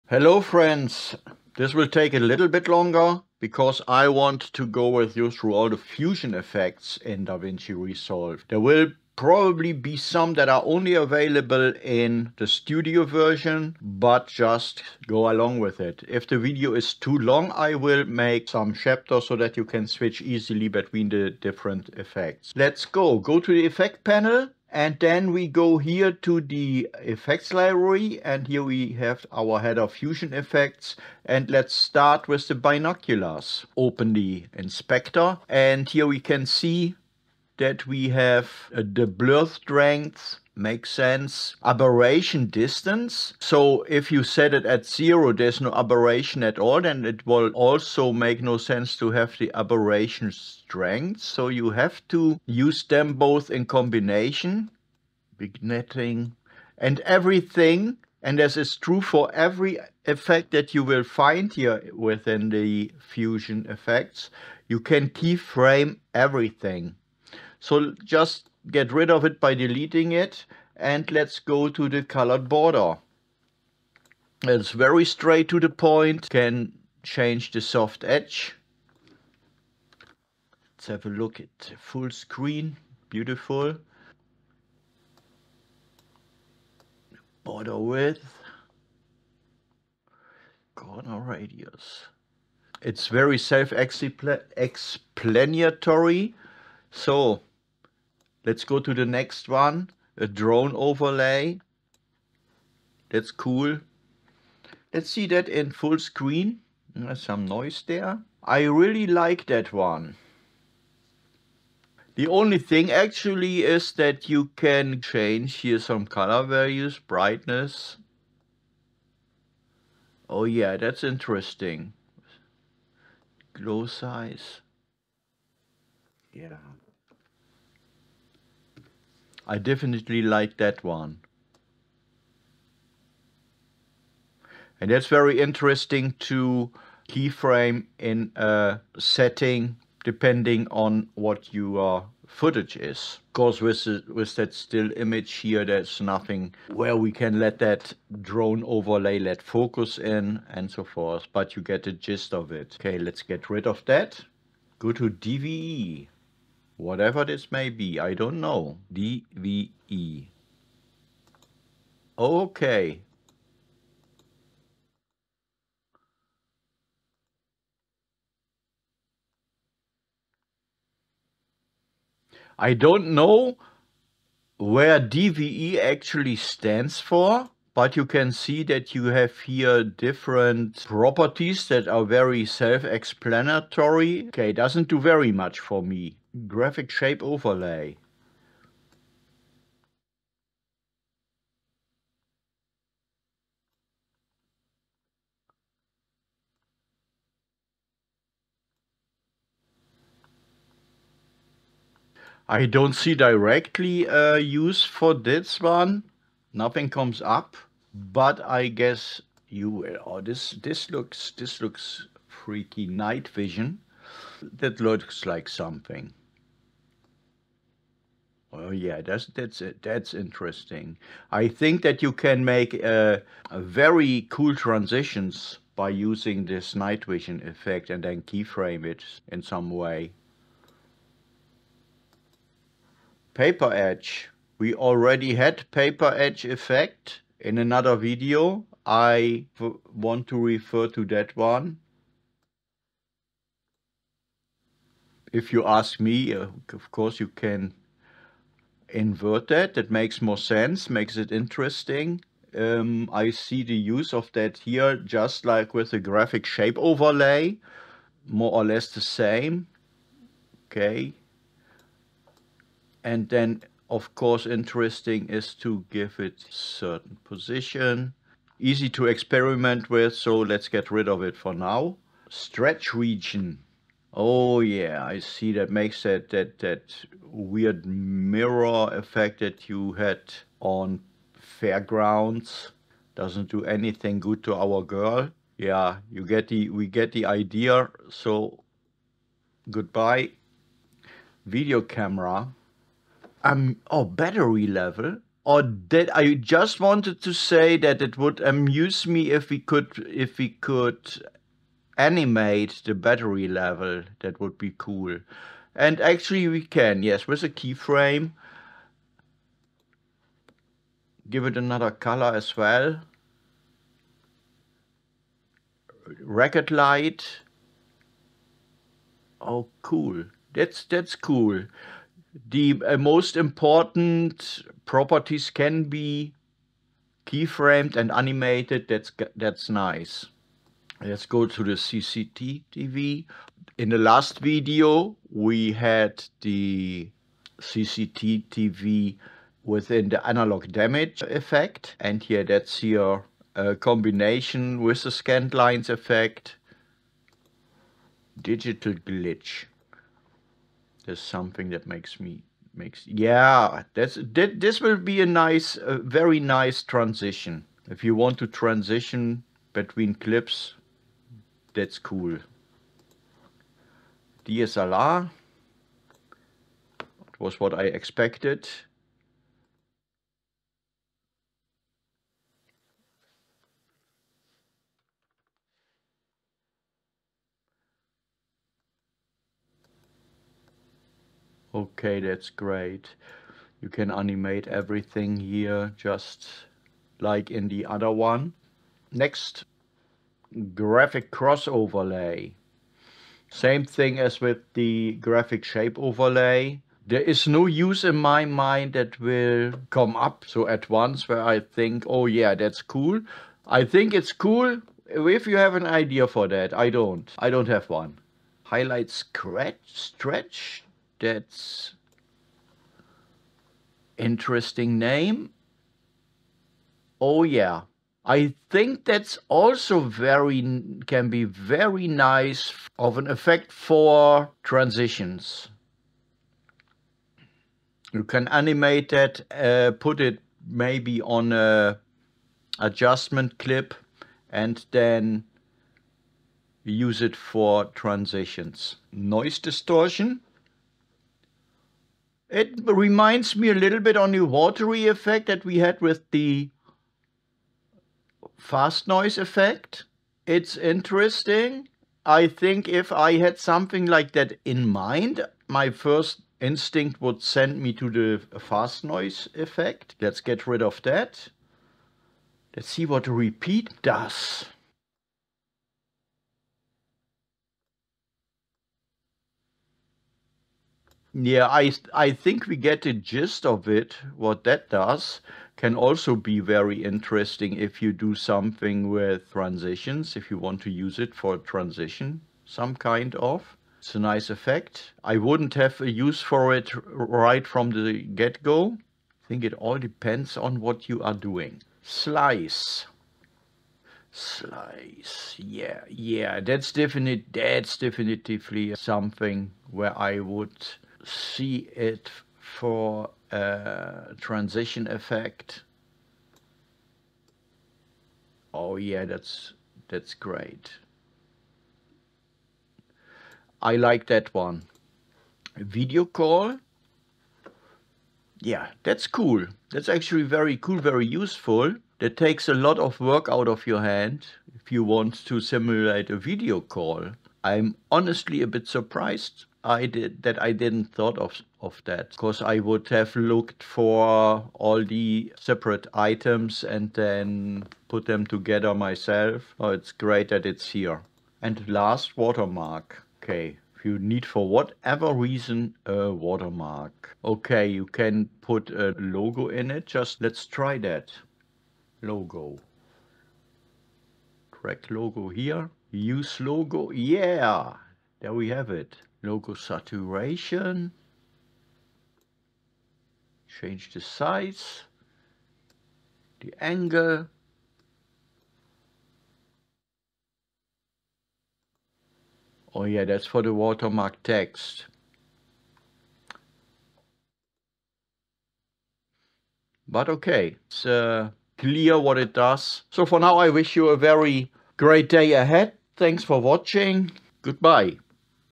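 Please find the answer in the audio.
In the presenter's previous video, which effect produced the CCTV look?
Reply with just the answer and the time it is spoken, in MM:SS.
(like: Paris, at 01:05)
Analog damage, at 05:40.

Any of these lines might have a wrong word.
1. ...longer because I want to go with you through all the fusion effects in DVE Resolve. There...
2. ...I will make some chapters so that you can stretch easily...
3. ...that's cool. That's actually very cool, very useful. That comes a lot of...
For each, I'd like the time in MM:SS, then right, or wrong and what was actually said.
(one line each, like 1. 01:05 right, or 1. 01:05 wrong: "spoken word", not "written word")
1. 00:02 wrong: "DaVinci", not "DVE"
2. 00:17 wrong: "switch", not "stretch"
3. 08:39 wrong: "takes", not "comes".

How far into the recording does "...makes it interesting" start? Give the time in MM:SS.
04:10.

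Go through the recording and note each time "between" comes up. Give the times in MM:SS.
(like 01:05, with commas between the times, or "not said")
00:20, 05:59.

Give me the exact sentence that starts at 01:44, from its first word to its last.
Let's see that in full screen.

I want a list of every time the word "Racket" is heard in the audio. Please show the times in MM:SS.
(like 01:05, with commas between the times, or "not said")
05:16.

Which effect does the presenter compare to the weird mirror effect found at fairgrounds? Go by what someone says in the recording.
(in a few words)
Stretch region.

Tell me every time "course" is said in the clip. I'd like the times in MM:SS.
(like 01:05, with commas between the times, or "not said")
02:23, 04:06, 04:24.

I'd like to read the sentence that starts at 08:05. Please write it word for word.
I wouldn't have a use for it right from the get-go.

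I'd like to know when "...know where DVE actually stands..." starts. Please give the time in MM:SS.
02:53.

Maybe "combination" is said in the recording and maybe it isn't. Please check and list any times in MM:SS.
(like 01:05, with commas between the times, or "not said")
00:53, 05:43.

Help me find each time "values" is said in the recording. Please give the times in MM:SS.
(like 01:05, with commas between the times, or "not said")
01:56.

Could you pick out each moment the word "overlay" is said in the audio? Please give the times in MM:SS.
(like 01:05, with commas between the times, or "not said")
01:40, 02:28, 03:07, 04:16, 06:31, 06:35.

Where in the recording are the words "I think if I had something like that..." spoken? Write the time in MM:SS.
07:32.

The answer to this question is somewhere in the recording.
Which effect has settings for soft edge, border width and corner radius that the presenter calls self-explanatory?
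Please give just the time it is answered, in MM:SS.
01:12.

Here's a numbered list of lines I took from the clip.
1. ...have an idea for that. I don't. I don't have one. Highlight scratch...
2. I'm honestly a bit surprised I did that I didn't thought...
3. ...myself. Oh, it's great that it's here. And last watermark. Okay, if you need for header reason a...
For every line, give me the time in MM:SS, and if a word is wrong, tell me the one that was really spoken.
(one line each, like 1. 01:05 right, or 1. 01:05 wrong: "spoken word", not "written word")
1. 06:45 right
2. 08:47 right
3. 08:58 wrong: "whatever", not "header".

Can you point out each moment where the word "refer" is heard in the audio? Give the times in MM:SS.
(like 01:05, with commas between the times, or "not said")
04:00.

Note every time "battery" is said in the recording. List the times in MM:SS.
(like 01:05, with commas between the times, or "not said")
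04:54, 05:02.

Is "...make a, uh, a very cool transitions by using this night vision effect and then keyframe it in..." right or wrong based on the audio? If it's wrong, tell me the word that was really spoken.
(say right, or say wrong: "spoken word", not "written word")
right.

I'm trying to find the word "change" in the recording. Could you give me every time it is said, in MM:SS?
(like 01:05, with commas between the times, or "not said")
01:17, 01:55, 09:23.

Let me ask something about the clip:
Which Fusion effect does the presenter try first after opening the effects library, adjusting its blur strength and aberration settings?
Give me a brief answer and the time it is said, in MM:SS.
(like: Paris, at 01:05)
Binoculars, at 00:32.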